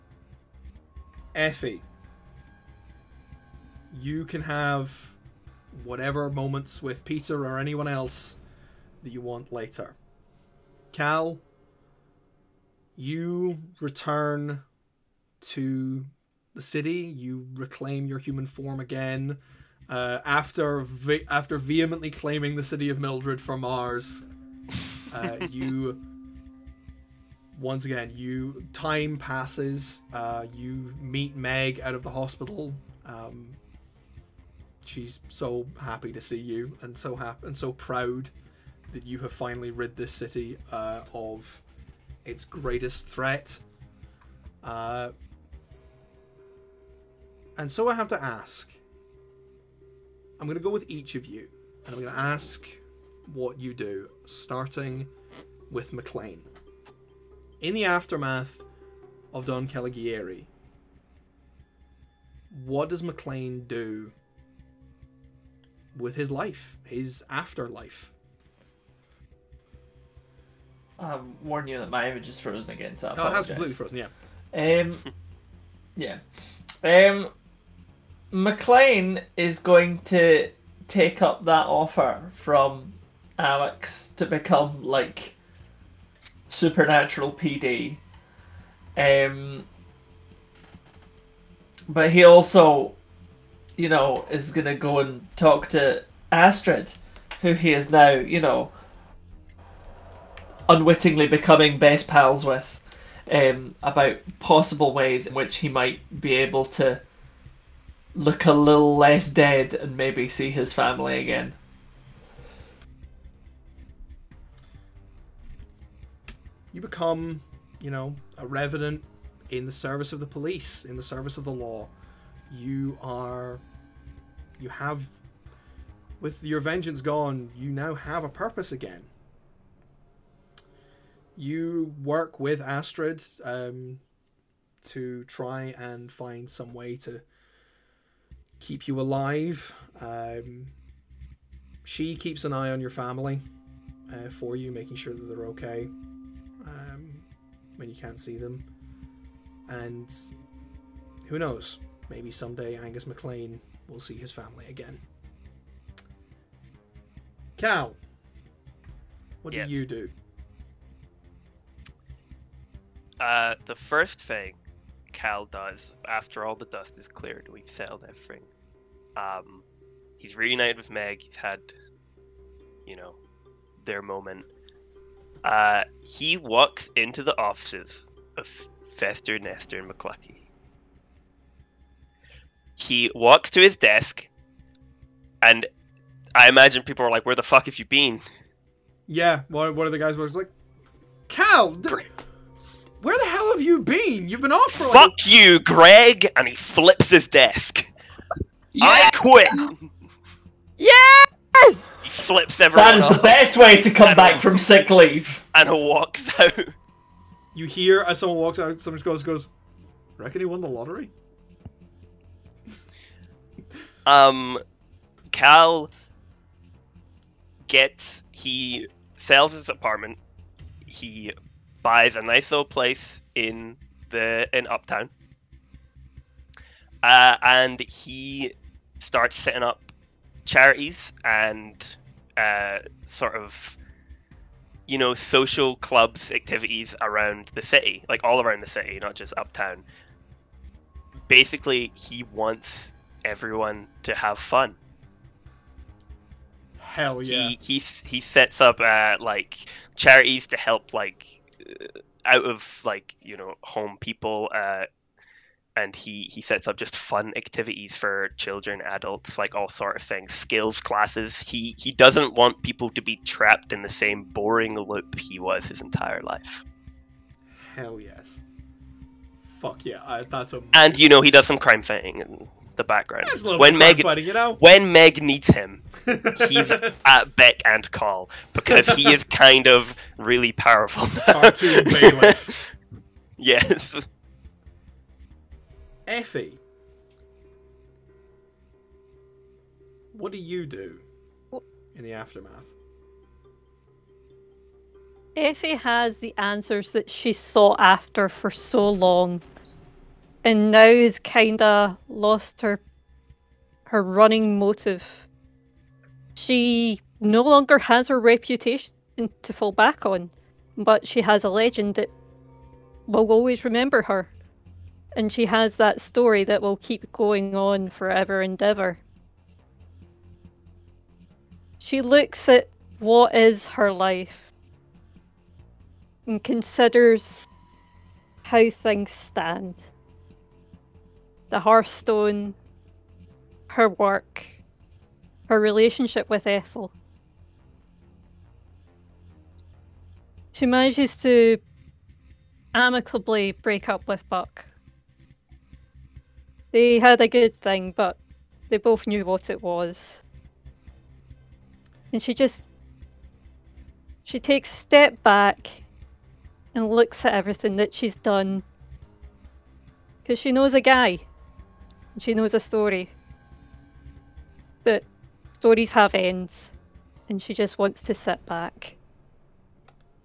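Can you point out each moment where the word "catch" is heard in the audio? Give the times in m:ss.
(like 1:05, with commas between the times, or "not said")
not said.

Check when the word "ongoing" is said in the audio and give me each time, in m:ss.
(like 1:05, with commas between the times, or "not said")
not said.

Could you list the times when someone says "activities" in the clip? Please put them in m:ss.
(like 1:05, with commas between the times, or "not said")
3:56, 4:17.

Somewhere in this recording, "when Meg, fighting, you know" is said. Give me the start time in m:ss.
4:33.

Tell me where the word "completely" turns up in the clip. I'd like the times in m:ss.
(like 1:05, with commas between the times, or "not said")
1:13.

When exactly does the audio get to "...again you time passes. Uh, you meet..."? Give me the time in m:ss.
0:27.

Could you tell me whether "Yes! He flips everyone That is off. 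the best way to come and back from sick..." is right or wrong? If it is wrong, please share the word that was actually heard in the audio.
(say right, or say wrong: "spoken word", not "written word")
right.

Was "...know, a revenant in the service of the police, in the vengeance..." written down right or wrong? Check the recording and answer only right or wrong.
wrong.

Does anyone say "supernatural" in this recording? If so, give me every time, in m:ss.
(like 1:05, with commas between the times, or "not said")
1:26.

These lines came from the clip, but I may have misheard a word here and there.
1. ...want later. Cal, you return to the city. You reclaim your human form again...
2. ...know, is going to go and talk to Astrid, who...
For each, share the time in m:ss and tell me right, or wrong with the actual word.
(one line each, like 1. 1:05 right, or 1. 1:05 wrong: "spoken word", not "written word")
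1. 0:09 right
2. 1:33 right.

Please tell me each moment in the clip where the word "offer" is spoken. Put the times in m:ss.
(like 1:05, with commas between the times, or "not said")
1:21.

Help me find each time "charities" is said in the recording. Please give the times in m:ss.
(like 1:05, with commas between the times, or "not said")
3:50, 4:09.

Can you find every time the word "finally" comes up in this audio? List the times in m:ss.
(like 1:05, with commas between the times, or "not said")
0:39.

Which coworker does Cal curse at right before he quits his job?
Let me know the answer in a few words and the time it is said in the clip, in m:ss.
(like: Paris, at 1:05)
Greg, at 3:15.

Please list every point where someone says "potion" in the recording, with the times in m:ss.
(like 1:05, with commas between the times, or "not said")
not said.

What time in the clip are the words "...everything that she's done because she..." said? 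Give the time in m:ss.
5:57.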